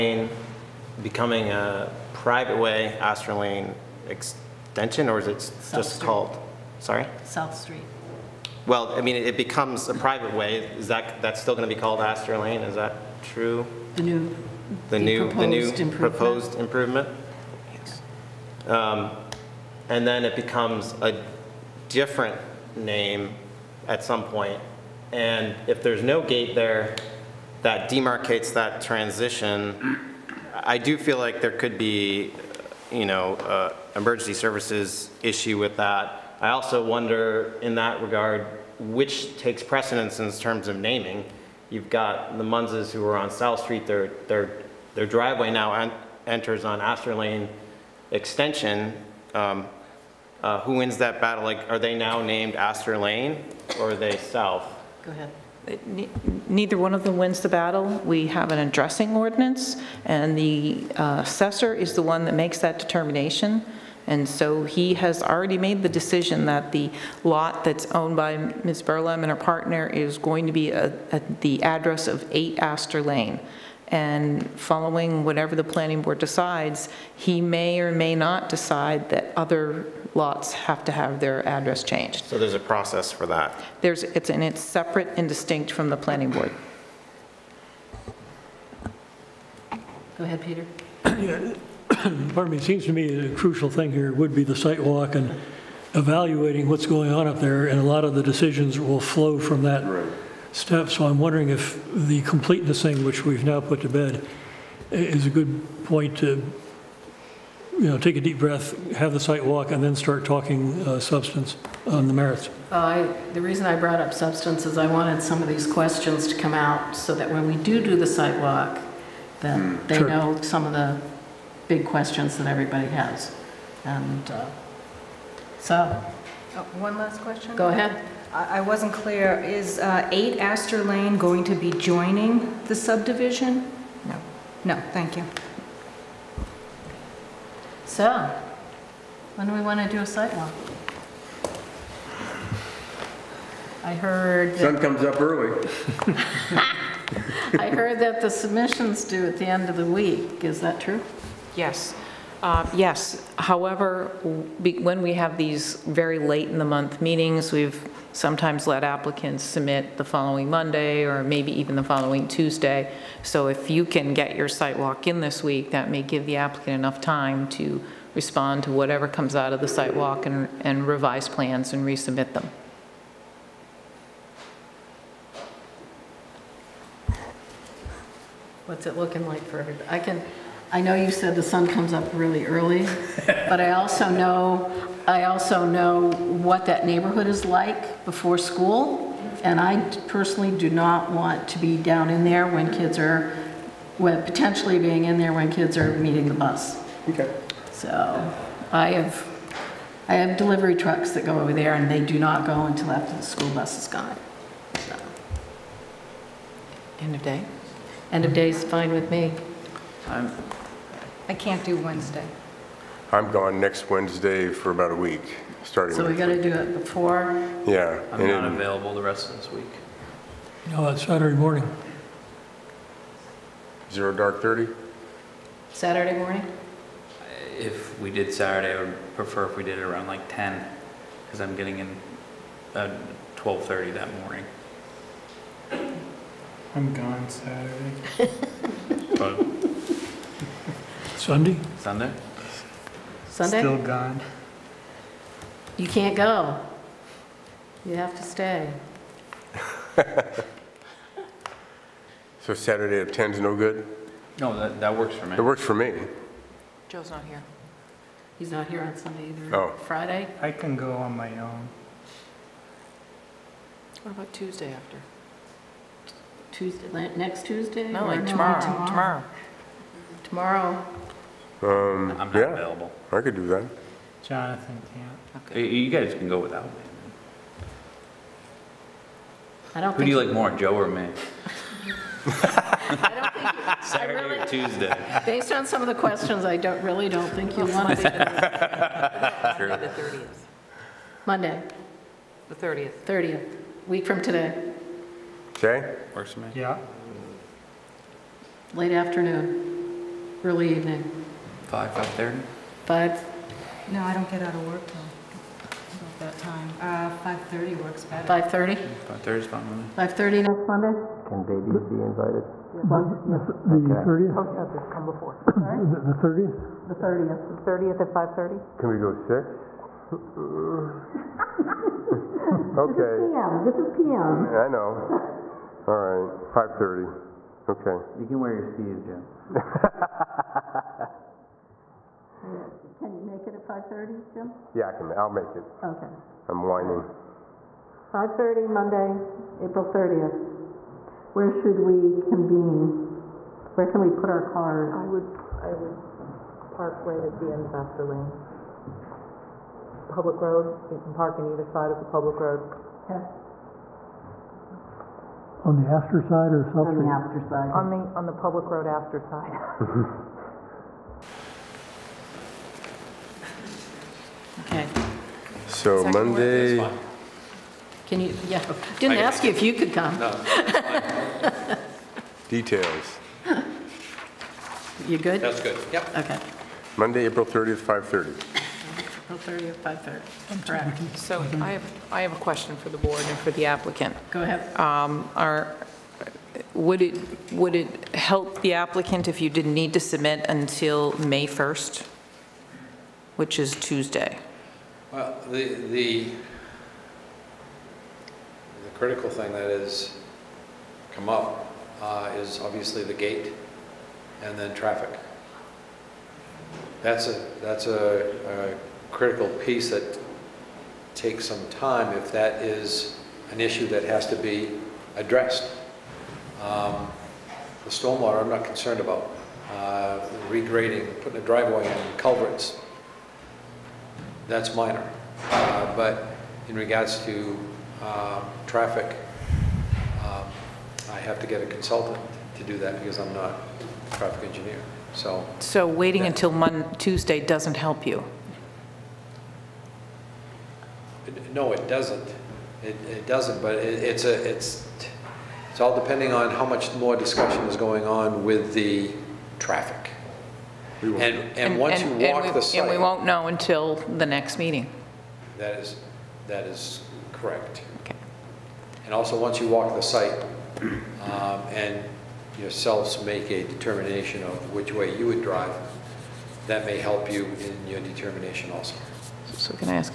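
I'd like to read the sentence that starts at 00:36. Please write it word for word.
I also wonder in that regard, which takes precedence in terms of naming.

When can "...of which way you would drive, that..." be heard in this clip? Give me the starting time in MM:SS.
07:44.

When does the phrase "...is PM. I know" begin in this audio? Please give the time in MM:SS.
05:23.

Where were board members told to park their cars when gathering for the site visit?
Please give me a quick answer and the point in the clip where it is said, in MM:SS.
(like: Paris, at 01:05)
End of Astor Lane, at 05:47.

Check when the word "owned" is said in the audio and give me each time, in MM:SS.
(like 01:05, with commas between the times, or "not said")
01:07.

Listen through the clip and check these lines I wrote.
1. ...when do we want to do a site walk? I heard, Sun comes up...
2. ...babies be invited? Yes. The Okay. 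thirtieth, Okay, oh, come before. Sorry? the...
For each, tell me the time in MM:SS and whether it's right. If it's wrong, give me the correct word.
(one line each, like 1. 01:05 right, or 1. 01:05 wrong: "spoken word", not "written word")
1. 02:19 right
2. 05:11 right.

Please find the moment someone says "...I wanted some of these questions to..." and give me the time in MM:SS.
01:54.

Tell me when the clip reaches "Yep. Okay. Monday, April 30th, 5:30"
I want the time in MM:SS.
06:15.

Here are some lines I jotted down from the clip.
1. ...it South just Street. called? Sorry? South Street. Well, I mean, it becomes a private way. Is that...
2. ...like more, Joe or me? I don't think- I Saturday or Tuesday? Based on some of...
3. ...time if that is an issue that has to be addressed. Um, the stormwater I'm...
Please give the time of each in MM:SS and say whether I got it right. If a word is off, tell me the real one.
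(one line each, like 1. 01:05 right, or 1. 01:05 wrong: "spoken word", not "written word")
1. 00:05 right
2. 04:40 right
3. 06:51 right.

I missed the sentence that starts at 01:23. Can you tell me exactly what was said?
There's, it's, and it's separate and distinct from the planning board.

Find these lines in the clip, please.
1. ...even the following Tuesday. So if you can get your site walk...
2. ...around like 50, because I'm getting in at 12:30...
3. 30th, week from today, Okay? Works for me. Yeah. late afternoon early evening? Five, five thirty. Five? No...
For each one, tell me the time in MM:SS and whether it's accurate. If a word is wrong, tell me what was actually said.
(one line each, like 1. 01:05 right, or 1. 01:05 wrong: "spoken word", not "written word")
1. 02:41 right
2. 03:49 wrong: "10", not "50"
3. 04:53 right.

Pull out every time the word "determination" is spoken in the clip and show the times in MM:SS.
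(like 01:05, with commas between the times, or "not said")
01:02, 07:43, 07:48.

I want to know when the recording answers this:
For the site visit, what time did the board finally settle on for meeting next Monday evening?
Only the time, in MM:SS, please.
05:38.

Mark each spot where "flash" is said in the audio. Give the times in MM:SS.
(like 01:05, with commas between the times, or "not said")
not said.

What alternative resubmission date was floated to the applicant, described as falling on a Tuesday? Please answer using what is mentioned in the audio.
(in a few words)
May 1st.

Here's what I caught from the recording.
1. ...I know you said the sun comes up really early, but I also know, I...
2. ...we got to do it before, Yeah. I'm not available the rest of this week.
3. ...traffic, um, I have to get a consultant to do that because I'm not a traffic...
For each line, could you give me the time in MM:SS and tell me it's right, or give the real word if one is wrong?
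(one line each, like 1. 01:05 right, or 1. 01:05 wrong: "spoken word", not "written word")
1. 03:00 right
2. 03:36 right
3. 07:08 right.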